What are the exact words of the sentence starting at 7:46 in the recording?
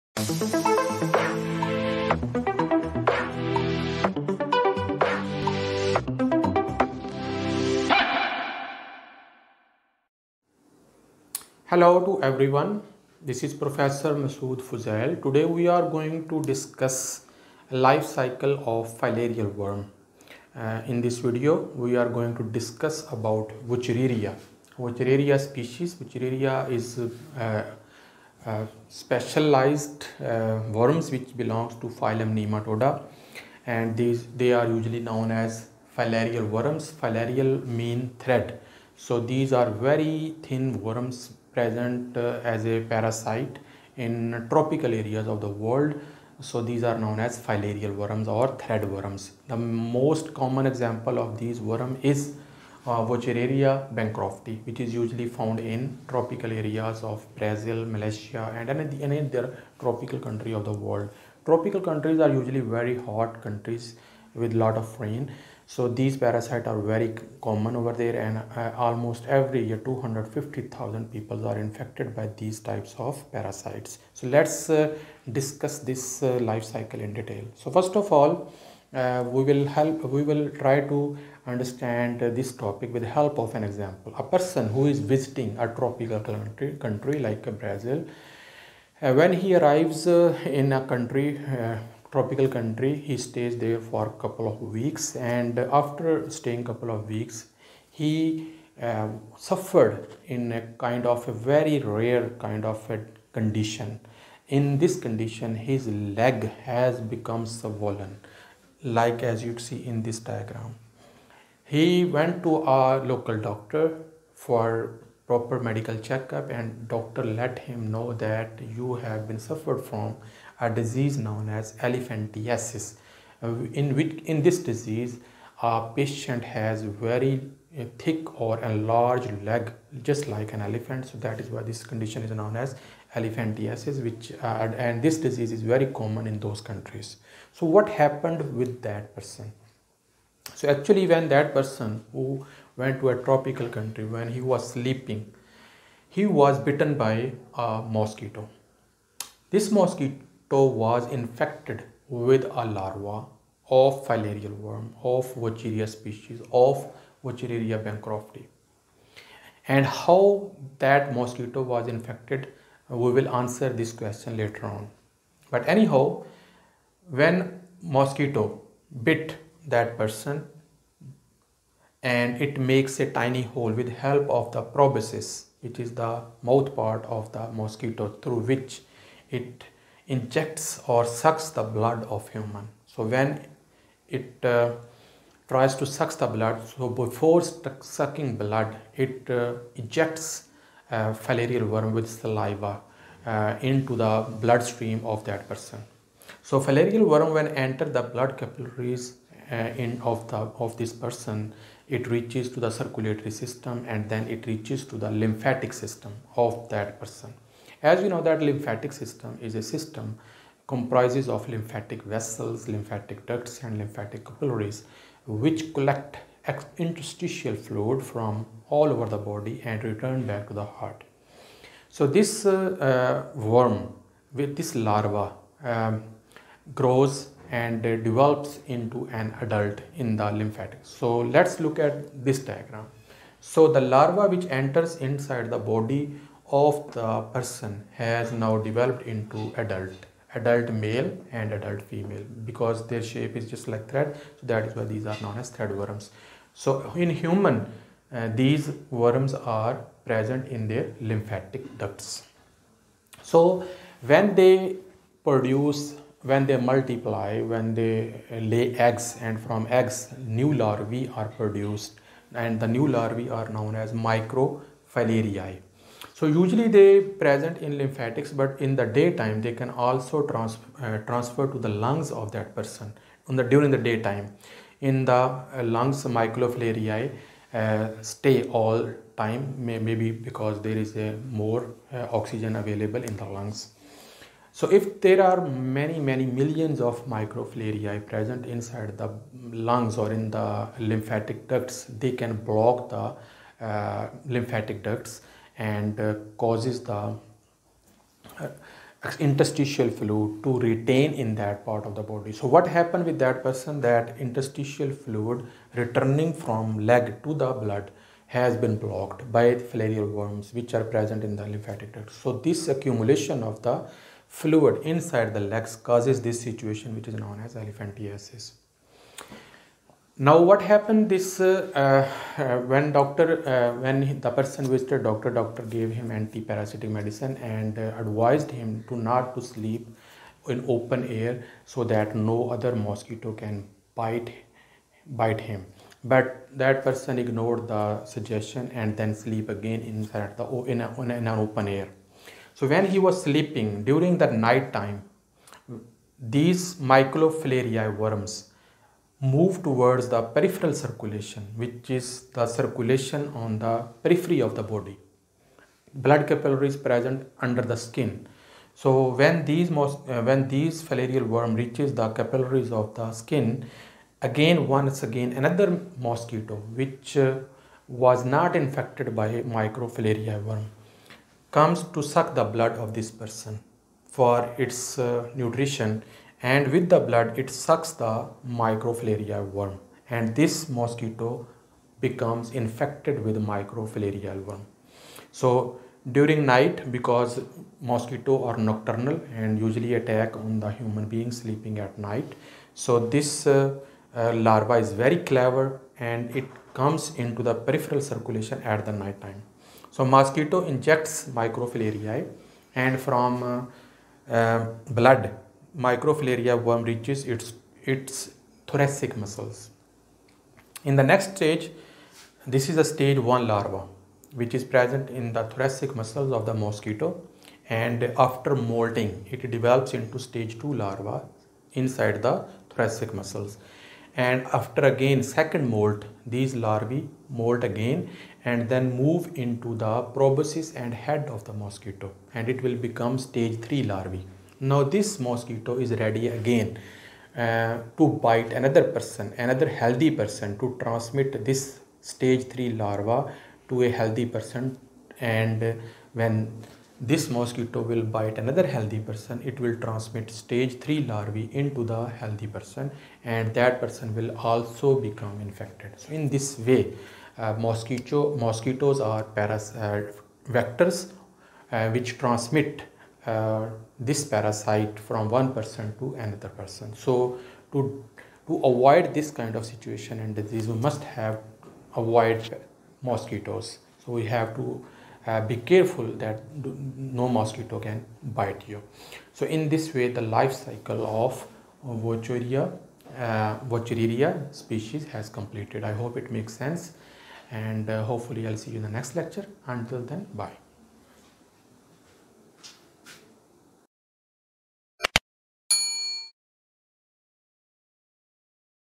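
So to, to avoid this kind of situation and disease, we must have avoid mosquitoes.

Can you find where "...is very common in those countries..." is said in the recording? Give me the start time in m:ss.
2:15.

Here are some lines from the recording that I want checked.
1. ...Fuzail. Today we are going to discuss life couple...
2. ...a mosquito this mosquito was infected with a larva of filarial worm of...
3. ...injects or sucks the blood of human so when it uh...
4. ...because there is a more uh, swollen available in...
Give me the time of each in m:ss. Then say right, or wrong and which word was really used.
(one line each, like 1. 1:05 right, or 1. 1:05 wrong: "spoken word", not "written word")
1. 0:14 wrong: "cycle", not "couple"
2. 2:27 right
3. 3:00 right
4. 4:40 wrong: "oxygen", not "swollen".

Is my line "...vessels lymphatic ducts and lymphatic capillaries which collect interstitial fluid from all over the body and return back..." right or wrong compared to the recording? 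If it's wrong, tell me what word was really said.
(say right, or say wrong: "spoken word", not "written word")
right.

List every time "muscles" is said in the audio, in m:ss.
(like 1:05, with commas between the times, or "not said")
6:49, 6:55, 7:03.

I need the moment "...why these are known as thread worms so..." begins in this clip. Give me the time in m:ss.
4:04.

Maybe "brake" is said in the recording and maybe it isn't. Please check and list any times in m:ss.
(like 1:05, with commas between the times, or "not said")
not said.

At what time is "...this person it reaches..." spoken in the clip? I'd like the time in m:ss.
3:20.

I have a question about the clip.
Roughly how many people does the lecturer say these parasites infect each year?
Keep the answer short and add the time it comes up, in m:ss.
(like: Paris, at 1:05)
250,000, at 1:09.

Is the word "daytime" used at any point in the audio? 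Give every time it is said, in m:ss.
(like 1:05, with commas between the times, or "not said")
4:28, 4:33.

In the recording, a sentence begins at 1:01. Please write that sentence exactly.
Tropical countries are usually very hot countries with lot of rain.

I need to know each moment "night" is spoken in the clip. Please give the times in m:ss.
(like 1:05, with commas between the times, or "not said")
5:44, 6:26, 6:31, 6:38.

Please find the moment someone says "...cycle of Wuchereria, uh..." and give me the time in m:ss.
8:00.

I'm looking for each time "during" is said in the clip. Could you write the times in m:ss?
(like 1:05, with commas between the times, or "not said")
4:33, 5:43, 6:26.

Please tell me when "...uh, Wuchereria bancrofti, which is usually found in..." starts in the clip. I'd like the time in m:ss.
0:52.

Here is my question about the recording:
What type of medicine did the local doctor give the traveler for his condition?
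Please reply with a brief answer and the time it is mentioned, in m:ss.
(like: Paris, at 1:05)
anti-parasitic medicine, at 5:26.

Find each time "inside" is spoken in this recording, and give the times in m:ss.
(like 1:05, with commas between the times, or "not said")
3:54, 4:48, 5:14, 5:39, 7:01.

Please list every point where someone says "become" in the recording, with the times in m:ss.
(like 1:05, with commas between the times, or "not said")
1:47, 6:22, 7:12, 7:35.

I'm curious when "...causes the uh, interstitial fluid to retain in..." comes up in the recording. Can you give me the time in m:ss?
4:56.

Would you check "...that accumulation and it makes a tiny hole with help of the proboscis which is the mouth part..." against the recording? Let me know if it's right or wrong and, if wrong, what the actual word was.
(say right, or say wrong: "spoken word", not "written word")
wrong: "person", not "accumulation".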